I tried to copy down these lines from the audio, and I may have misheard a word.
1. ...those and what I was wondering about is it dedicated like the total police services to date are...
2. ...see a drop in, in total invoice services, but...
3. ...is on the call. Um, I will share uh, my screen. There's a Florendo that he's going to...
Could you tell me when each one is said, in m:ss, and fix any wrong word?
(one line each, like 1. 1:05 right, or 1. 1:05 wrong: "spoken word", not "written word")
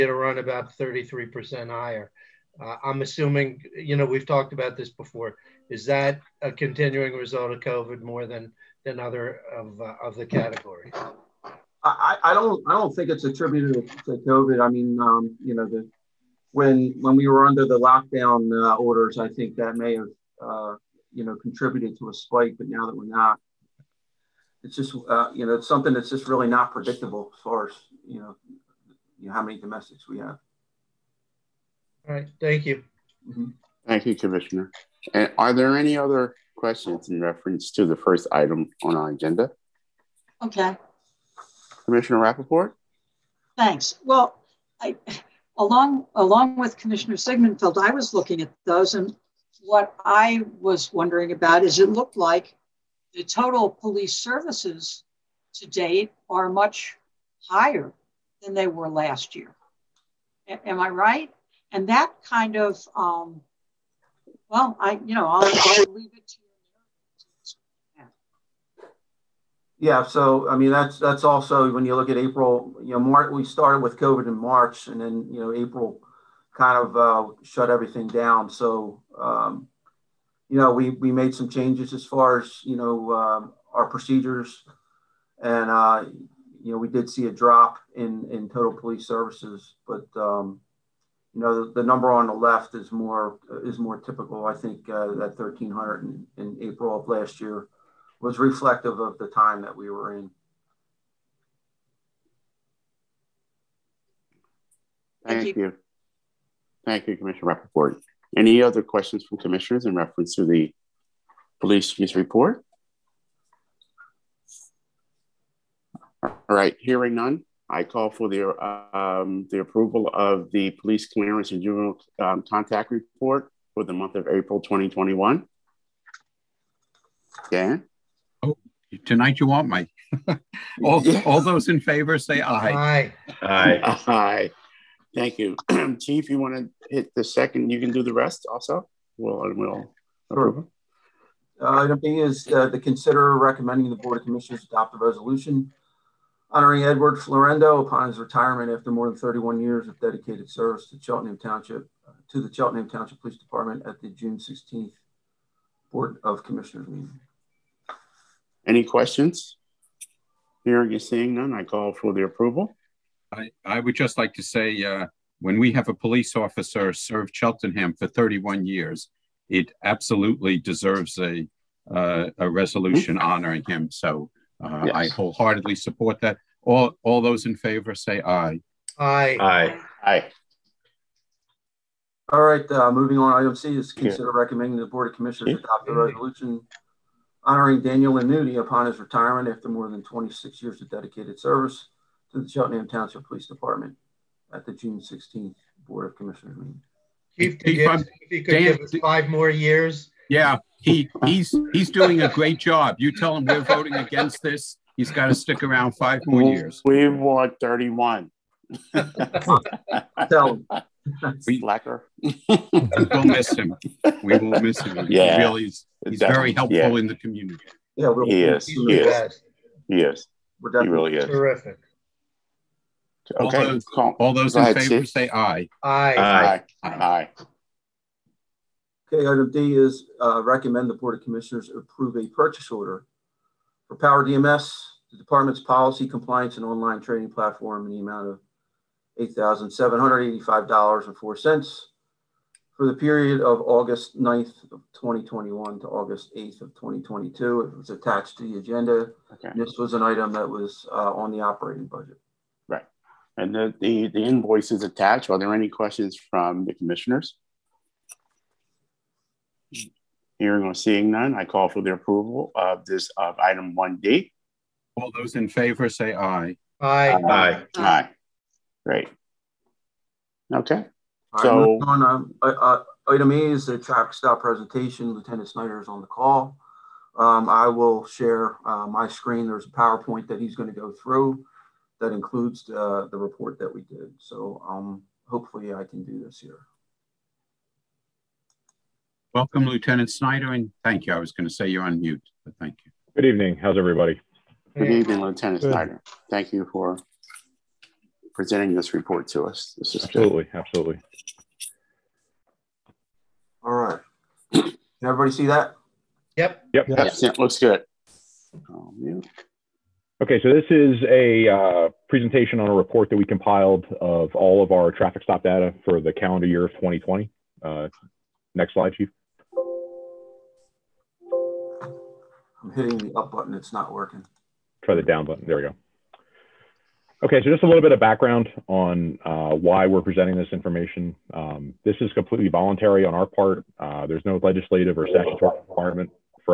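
1. 0:48 wrong: "looked", not "dedicated"
2. 1:27 wrong: "police", not "invoice"
3. 4:35 wrong: "PowerPoint", not "Florendo".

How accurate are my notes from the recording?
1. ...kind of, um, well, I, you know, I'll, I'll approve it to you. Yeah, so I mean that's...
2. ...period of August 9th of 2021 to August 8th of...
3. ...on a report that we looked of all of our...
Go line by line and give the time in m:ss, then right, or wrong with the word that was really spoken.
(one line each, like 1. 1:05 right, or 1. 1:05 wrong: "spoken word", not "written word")
1. 1:02 wrong: "leave", not "approve"
2. 4:02 right
3. 5:12 wrong: "compiled", not "looked".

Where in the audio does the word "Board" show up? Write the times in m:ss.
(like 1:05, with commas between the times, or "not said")
2:23, 2:35, 3:04, 3:15, 3:50.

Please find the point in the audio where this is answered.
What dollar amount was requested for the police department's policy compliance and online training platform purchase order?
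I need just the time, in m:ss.
3:59.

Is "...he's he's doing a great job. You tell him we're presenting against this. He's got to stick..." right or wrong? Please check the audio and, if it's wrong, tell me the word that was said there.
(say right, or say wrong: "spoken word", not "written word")
wrong: "voting", not "presenting".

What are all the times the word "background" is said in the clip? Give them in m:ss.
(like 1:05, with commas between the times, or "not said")
5:27.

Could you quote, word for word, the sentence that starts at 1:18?
So um, you know, we, we made some changes as far as, you know, um, our procedures.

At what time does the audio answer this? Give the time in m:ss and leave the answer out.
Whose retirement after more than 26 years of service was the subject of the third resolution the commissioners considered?
3:07.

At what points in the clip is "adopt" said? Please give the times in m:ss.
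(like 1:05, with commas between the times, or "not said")
2:24, 3:05.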